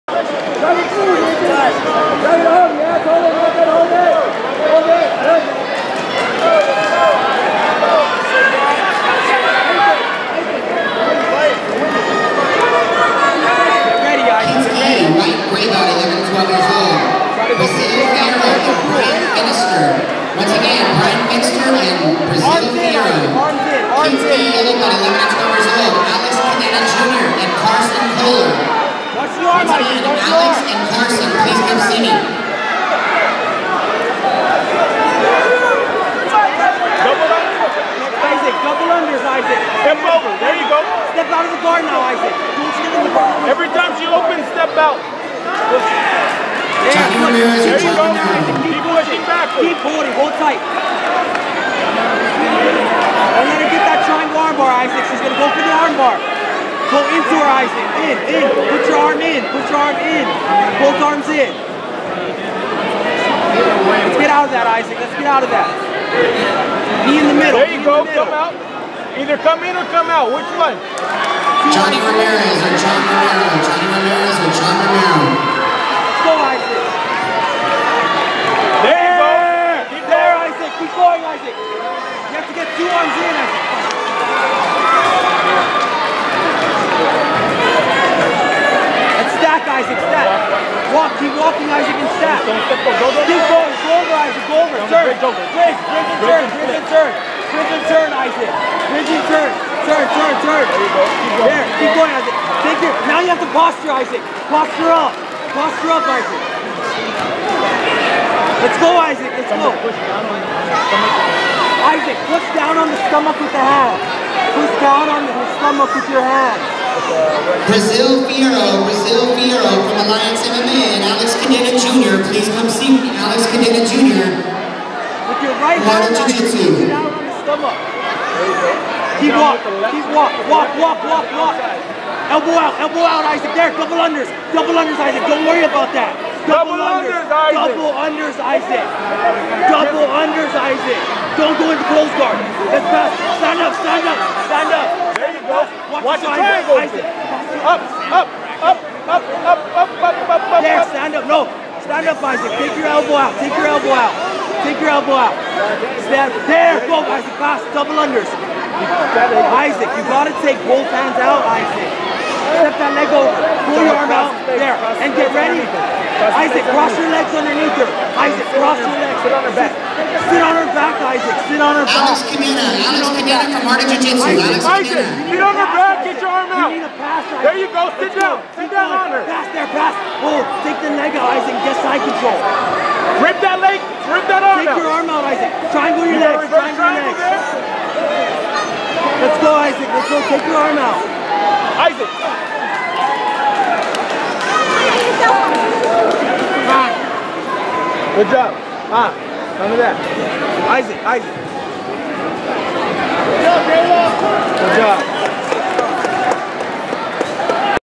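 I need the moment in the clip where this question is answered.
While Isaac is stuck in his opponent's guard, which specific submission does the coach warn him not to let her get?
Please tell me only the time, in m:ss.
0:54.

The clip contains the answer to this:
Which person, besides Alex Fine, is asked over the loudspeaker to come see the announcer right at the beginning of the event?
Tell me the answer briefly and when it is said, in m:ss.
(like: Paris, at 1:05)
Carson, at 0:30.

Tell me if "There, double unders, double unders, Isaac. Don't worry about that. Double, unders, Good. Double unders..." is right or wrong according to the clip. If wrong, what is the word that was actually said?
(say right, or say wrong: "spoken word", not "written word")
wrong: "Isaac", not "Good".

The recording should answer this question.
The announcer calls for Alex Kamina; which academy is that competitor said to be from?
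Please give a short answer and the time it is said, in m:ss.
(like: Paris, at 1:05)
Marty Jiu Jitsu, at 2:53.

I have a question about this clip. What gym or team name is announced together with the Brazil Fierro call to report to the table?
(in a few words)
Alliance MMA.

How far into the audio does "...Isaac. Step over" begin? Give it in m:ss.
0:39.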